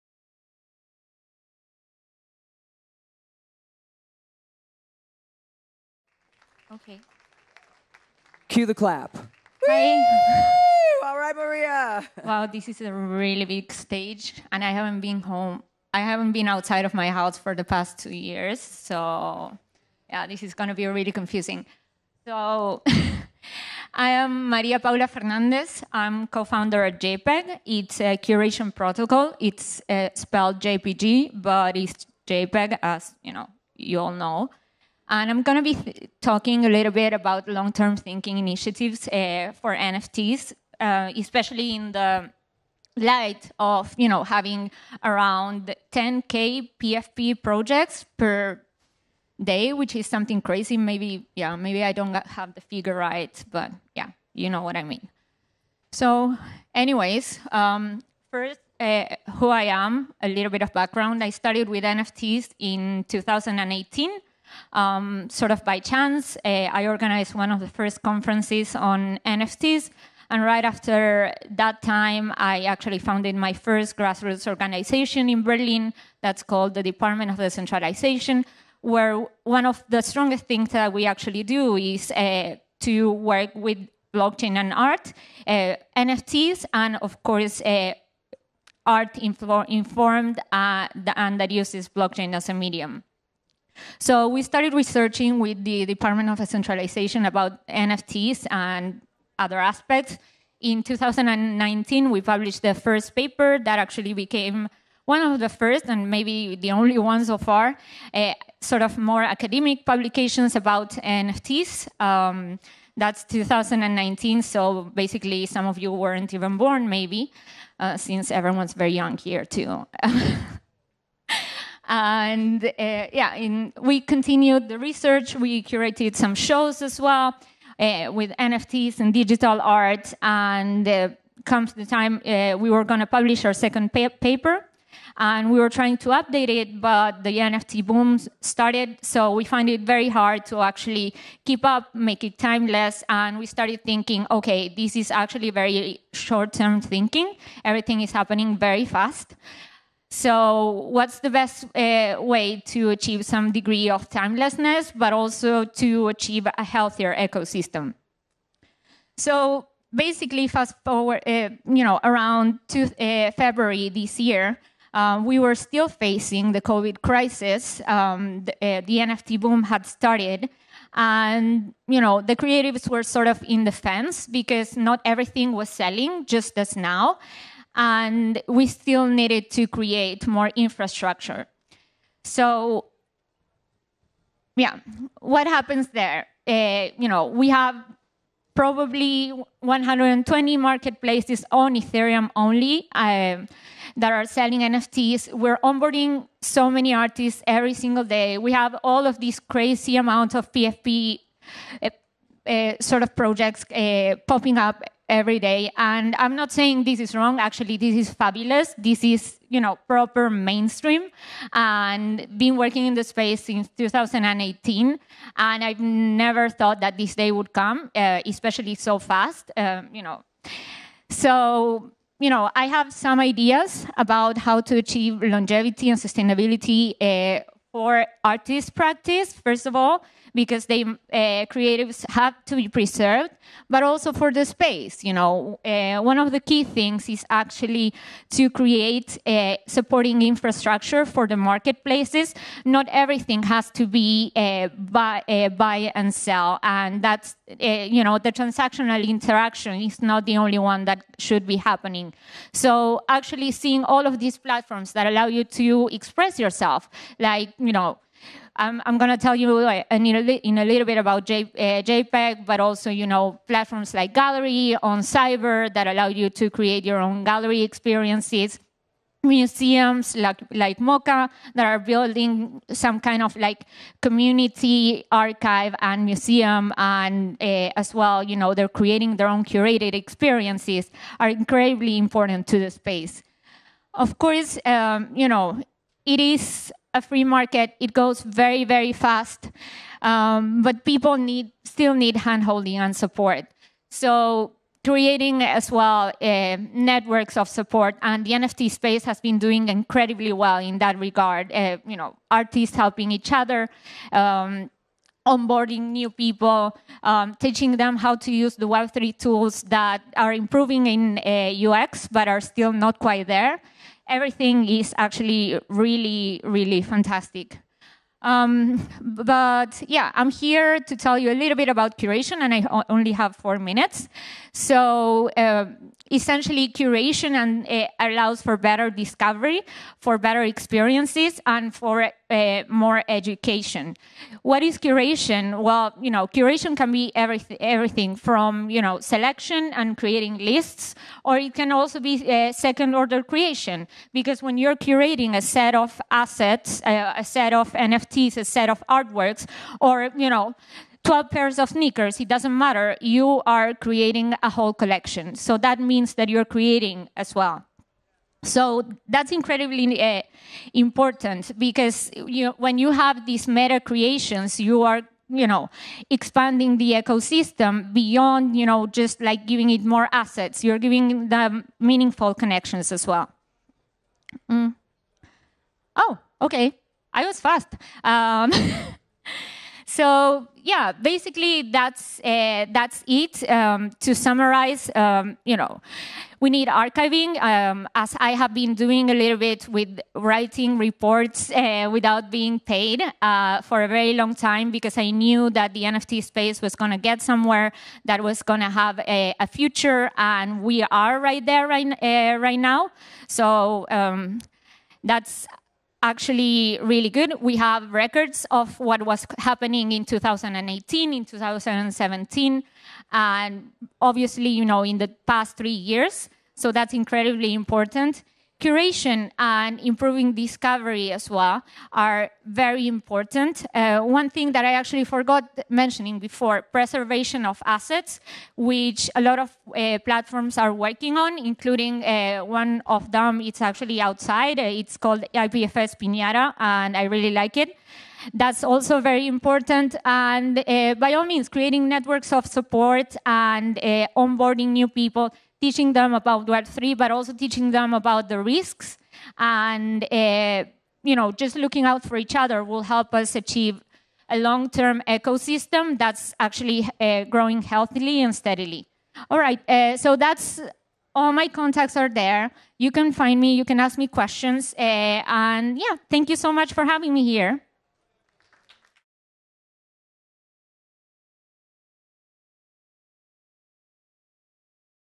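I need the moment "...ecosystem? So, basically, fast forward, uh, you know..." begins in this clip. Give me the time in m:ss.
2:37.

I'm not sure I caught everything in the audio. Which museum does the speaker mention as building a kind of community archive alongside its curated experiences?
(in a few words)
MOCA.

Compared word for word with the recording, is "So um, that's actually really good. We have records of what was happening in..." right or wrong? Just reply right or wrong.
right.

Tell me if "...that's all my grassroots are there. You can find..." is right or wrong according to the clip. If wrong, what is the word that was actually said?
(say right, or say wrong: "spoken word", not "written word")
wrong: "contacts", not "grassroots".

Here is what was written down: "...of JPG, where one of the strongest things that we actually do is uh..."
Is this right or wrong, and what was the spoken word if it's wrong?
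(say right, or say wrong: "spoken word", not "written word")
wrong: "Decentralization", not "JPG".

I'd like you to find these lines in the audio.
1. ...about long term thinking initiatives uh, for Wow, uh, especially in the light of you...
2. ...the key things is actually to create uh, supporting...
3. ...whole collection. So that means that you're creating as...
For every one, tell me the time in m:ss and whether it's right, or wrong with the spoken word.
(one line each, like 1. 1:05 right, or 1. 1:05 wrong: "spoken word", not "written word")
1. 0:37 wrong: "NFTs", not "Wow"
2. 3:56 right
3. 5:54 right.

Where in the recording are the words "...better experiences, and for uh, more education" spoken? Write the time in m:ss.
5:30.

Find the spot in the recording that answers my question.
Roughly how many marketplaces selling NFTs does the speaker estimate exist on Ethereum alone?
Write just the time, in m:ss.
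3:09.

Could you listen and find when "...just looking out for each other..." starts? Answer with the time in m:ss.
7:31.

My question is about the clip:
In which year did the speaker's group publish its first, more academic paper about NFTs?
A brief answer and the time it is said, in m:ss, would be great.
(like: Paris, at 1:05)
2019, at 1:40.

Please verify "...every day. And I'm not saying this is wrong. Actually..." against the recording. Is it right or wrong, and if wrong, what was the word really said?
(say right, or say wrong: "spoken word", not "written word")
right.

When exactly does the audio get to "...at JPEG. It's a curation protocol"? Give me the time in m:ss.
0:26.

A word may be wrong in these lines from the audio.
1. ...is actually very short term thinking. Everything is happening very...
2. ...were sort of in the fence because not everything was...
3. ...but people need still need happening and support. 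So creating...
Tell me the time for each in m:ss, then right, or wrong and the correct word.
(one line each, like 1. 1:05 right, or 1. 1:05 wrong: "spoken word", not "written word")
1. 2:24 right
2. 2:52 right
3. 4:50 wrong: "handholding", not "happening".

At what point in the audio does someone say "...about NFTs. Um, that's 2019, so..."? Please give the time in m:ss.
1:50.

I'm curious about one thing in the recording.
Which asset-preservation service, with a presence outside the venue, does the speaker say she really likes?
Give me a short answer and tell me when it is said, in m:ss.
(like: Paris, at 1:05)
IPFS Pinata, at 7:15.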